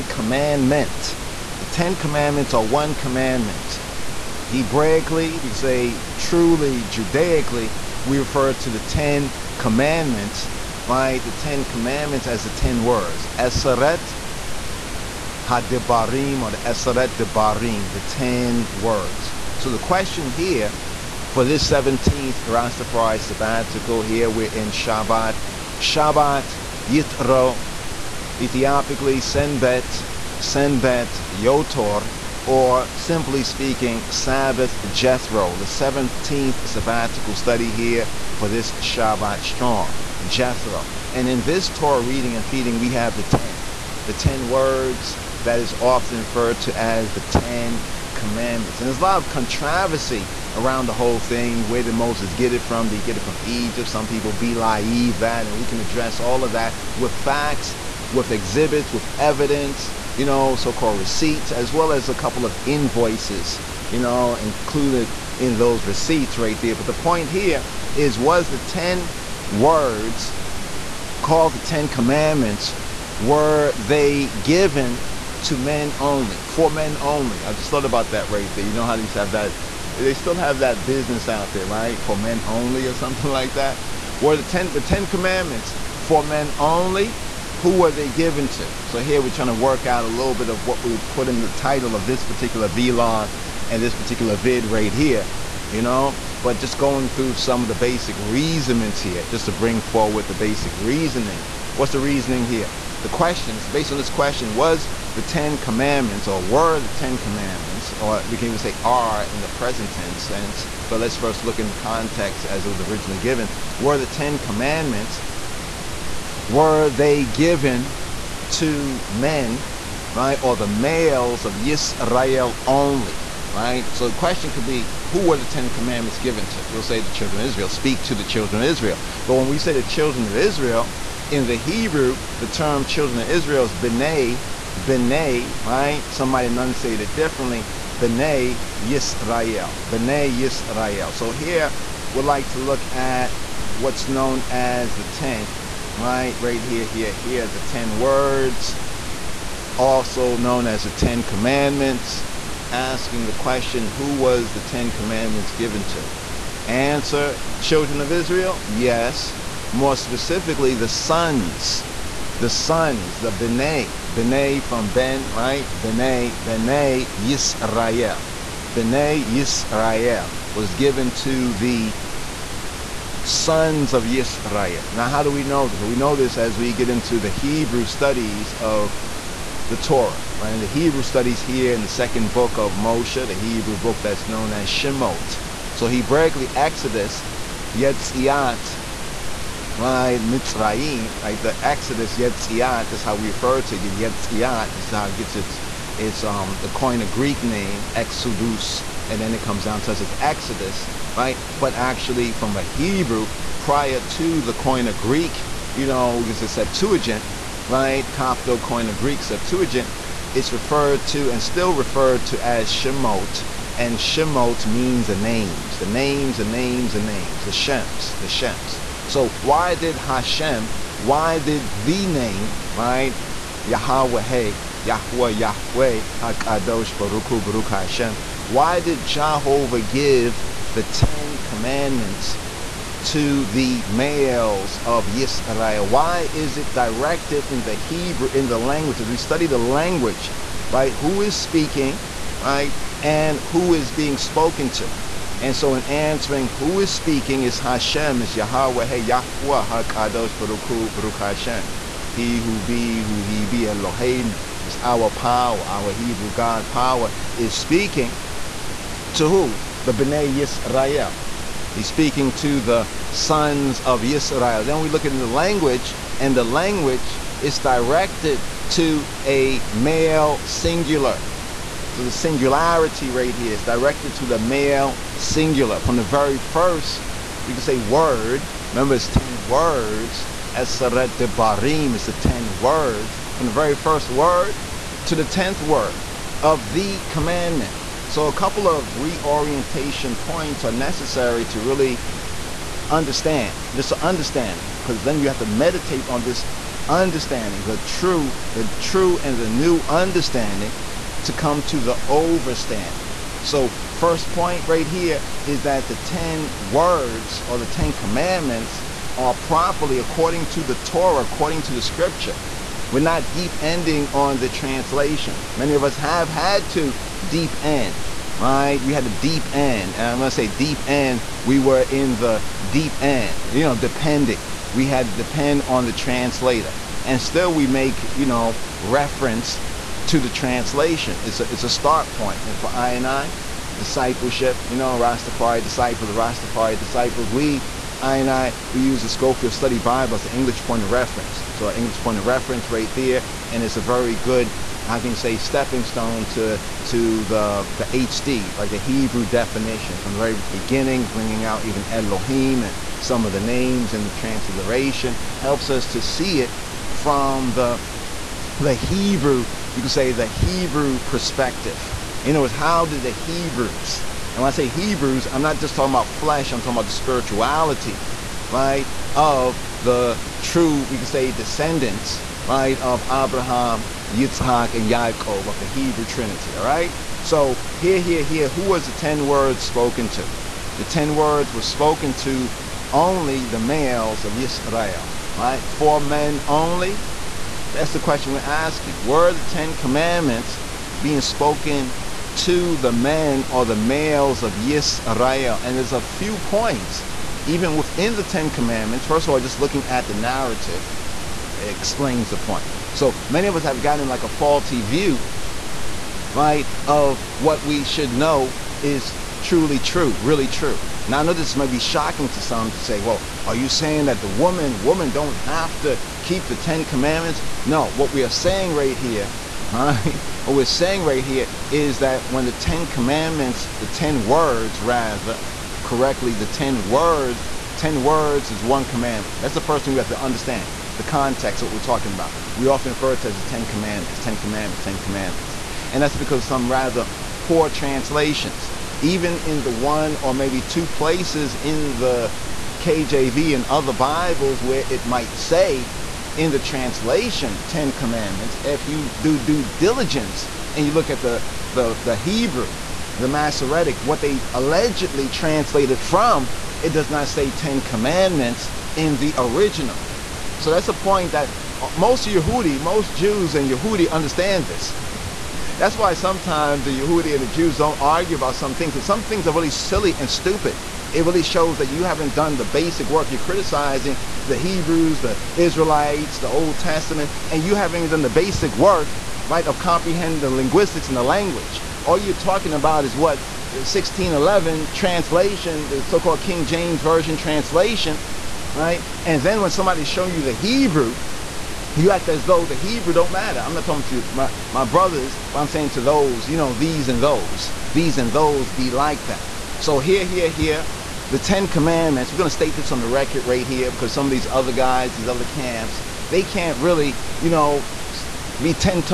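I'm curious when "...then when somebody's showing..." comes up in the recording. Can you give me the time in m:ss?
8:09.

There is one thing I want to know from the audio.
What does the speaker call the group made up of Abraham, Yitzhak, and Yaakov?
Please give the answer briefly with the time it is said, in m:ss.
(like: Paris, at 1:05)
Hebrew Trinity, at 6:15.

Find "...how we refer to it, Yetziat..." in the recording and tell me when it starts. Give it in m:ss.
3:13.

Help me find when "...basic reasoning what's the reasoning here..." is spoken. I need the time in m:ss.
1:40.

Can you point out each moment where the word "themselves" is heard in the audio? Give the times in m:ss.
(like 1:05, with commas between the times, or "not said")
not said.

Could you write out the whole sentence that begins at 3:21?
But actually from a Hebrew, prior to the Koine Greek, you know, because it's Septuagint, right?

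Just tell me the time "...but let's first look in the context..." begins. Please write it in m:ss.
1:50.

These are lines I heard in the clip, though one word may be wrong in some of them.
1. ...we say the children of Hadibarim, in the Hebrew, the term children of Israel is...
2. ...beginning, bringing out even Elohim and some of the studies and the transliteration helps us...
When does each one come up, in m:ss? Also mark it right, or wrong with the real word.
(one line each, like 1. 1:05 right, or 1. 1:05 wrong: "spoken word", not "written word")
1. 2:09 wrong: "Israel", not "Hadibarim"
2. 5:50 wrong: "names", not "studies".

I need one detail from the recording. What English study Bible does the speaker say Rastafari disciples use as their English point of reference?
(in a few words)
Scofield Study Bible.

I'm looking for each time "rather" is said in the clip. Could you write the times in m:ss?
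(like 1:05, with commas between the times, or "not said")
7:04, 7:16.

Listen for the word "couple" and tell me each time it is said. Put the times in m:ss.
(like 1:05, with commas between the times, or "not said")
1:02, 4:48.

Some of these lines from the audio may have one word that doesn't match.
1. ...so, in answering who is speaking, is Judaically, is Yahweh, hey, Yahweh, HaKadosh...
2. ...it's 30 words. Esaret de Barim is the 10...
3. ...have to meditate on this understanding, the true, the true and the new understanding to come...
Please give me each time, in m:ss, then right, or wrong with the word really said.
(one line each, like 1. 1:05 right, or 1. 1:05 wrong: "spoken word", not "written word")
1. 4:05 wrong: "Hashem", not "Judaically"
2. 4:38 wrong: "10", not "30"
3. 4:55 right.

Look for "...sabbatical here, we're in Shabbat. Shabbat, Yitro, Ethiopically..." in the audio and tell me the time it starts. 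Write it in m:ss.
0:23.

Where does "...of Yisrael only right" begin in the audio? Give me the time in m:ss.
2:01.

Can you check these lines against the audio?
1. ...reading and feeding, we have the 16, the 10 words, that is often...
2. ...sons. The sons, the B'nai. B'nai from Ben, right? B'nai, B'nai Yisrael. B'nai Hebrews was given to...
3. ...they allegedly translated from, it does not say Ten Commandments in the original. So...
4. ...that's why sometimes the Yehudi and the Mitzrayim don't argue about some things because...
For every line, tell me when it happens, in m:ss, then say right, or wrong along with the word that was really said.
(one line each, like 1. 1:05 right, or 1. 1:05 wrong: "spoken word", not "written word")
1. 0:42 wrong: "10", not "16"
2. 2:40 wrong: "Yisrael", not "Hebrews"
3. 7:34 right
4. 7:45 wrong: "Jews", not "Mitzrayim".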